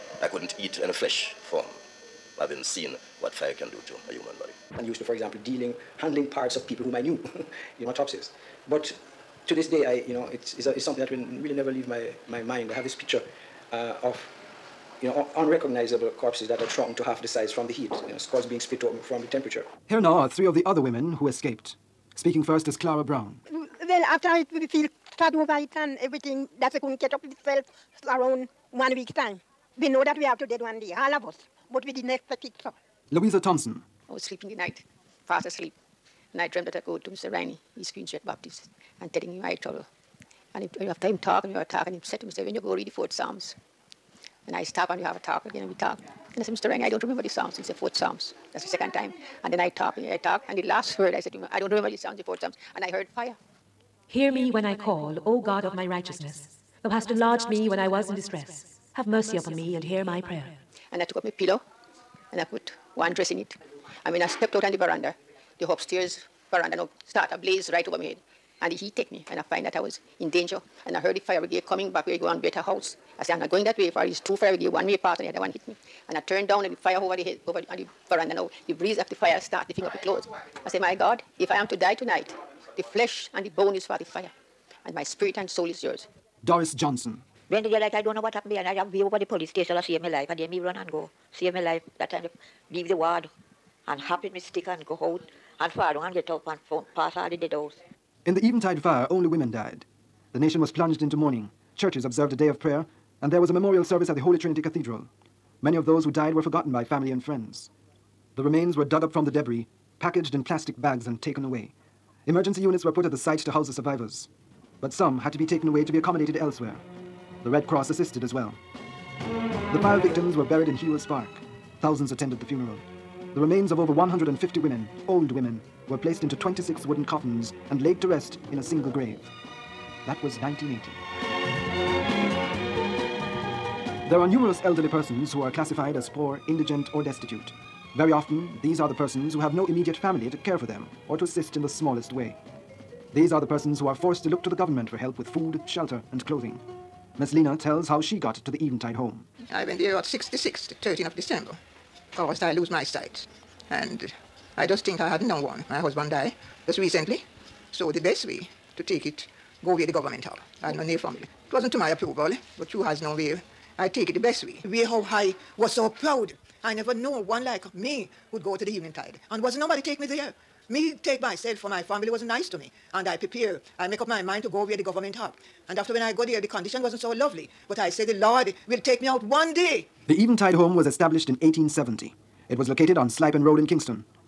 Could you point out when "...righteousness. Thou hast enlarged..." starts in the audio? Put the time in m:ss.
0:55.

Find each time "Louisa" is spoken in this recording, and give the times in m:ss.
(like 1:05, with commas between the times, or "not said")
0:33.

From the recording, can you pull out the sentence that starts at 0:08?
But to this day, I, you know, it's, it's, a, it's, something that will really never leave my, my mind.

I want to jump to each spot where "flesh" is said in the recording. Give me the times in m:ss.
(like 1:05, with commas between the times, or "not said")
0:00, 1:22.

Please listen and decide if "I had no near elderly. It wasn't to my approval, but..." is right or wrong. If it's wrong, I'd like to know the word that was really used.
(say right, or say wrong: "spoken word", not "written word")
wrong: "family", not "elderly".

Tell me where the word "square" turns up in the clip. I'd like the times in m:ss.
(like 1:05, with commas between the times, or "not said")
not said.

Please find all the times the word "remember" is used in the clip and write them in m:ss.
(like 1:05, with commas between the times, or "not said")
0:47, 0:51.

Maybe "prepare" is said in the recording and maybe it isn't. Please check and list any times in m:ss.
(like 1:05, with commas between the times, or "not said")
2:53.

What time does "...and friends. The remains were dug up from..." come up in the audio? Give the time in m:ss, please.
1:47.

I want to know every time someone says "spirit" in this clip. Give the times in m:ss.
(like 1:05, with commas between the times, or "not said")
1:25.